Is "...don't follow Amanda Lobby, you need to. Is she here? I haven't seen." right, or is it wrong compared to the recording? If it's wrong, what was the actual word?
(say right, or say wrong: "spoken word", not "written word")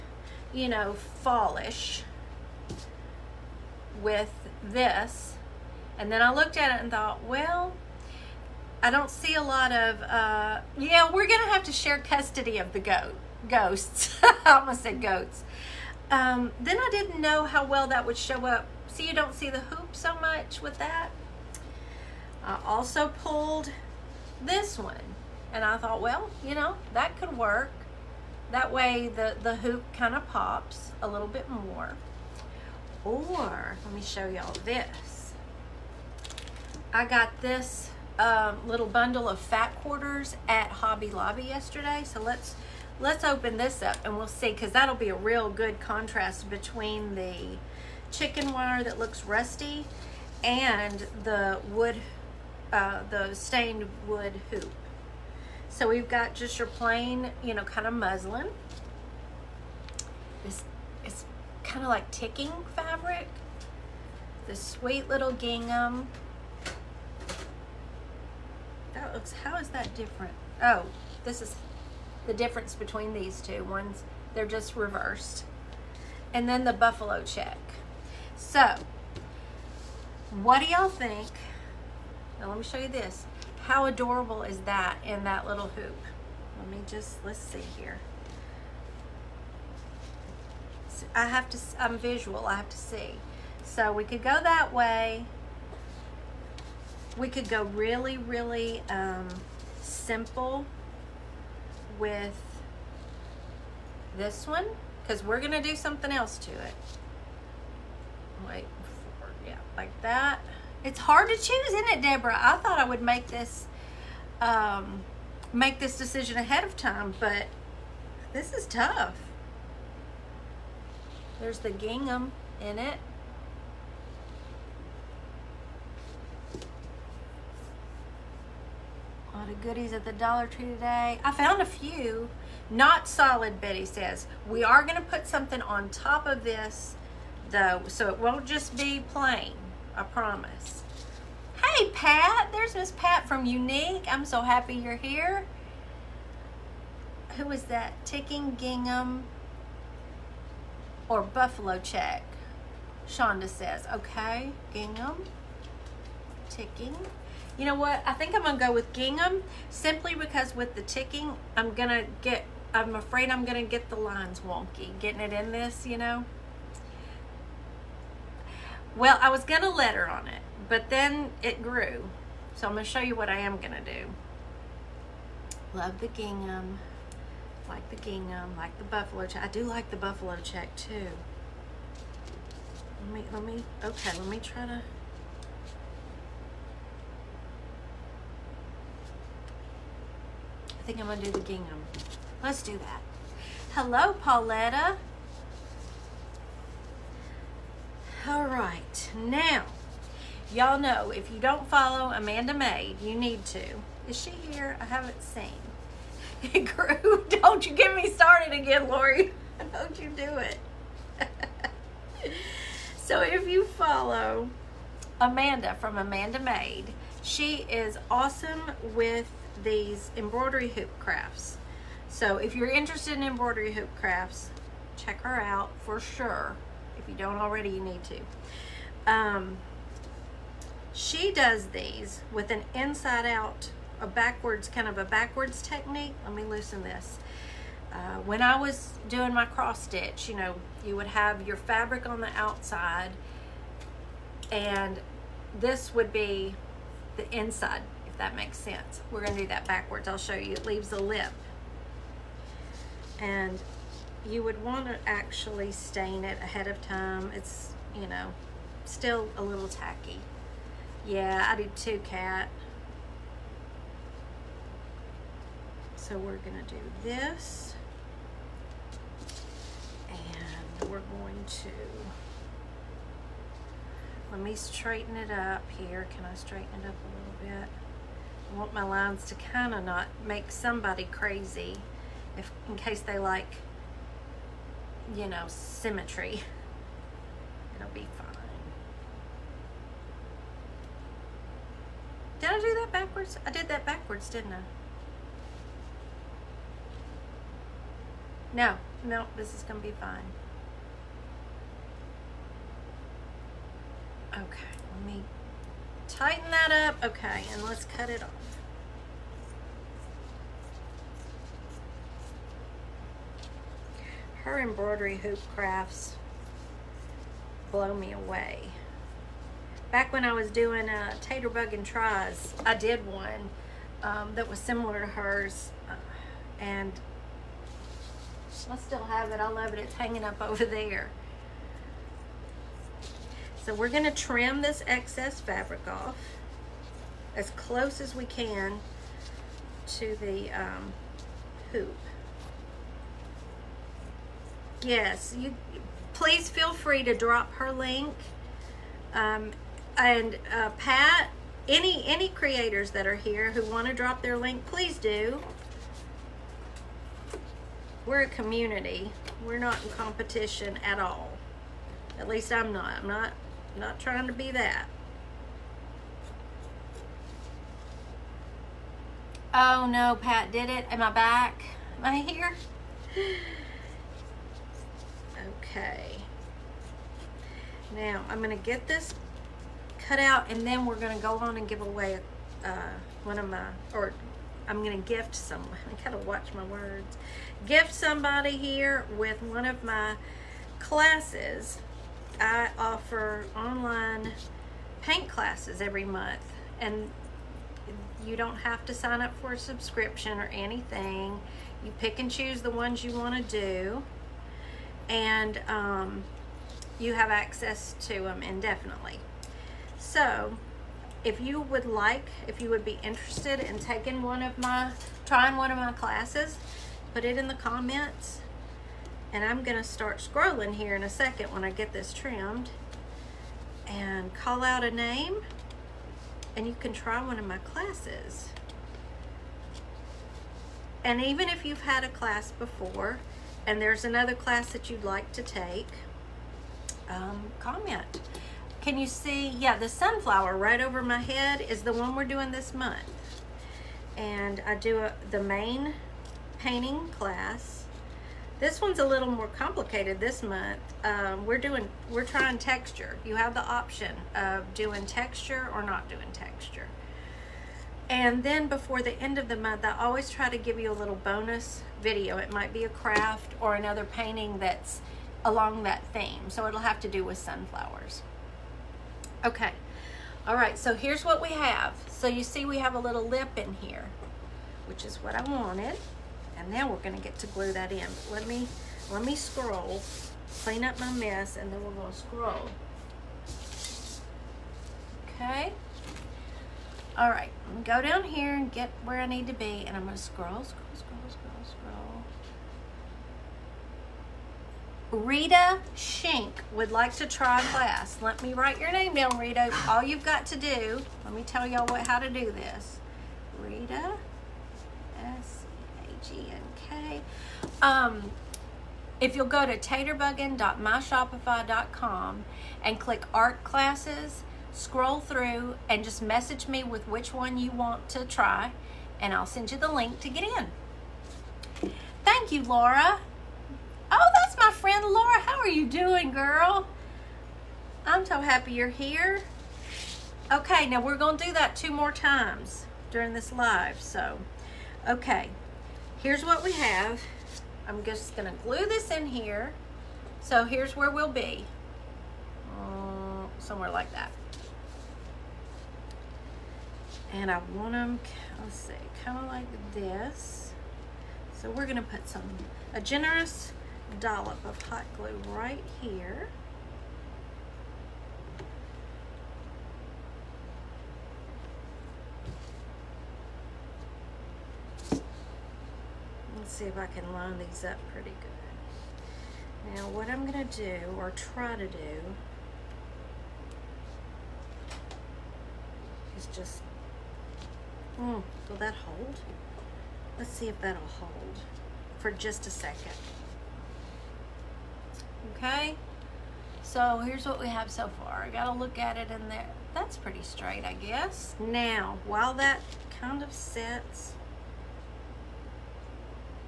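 wrong: "Maid", not "Lobby".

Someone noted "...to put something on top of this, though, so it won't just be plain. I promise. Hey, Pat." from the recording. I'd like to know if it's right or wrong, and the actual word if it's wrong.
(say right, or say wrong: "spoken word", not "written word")
right.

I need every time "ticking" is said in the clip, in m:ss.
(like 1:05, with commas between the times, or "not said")
1:02, 2:28, 2:36, 2:40.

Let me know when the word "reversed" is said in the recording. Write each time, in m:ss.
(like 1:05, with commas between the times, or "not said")
1:14.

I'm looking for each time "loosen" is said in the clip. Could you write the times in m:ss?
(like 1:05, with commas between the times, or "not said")
3:56.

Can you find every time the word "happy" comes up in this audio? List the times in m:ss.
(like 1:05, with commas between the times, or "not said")
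2:24, 8:48.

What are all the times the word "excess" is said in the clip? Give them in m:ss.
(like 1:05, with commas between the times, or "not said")
5:34.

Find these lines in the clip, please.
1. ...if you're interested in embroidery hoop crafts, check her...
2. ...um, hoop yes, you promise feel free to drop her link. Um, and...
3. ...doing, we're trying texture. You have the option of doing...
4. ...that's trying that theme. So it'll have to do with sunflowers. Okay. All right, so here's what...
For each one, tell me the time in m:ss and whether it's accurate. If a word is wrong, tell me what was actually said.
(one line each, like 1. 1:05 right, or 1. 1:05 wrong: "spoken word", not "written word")
1. 3:42 right
2. 5:40 wrong: "please", not "promise"
3. 7:31 right
4. 7:44 wrong: "along", not "trying".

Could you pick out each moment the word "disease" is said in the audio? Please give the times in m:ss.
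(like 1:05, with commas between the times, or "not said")
not said.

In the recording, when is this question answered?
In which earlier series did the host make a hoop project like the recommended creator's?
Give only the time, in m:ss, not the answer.
5:21.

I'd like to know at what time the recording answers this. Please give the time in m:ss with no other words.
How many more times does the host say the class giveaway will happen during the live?
8:51.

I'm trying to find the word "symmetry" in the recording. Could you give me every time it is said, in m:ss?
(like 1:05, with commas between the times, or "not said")
4:45.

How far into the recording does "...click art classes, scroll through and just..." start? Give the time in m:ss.
8:32.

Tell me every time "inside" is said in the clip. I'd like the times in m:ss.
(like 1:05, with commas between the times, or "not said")
3:52, 4:07.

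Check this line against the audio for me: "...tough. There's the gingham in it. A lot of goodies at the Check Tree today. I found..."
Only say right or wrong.
wrong.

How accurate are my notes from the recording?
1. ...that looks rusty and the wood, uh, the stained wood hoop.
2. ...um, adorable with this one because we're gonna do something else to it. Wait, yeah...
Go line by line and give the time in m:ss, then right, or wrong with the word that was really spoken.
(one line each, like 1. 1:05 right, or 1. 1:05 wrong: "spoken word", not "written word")
1. 0:48 right
2. 1:38 wrong: "simple", not "adorable".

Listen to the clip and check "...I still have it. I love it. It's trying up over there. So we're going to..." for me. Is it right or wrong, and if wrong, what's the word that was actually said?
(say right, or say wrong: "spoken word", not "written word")
wrong: "hanging", not "trying".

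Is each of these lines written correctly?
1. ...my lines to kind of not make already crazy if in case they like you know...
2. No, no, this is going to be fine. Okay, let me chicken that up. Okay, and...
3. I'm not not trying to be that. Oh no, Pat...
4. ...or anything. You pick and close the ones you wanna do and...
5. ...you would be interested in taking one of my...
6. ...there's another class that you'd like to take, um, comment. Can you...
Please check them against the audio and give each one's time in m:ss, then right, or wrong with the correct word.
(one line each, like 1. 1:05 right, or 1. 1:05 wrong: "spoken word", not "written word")
1. 4:38 wrong: "somebody", not "already"
2. 4:58 wrong: "tighten", not "chicken"
3. 6:03 right
4. 6:40 wrong: "choose", not "close"
5. 6:52 right
6. 7:13 right.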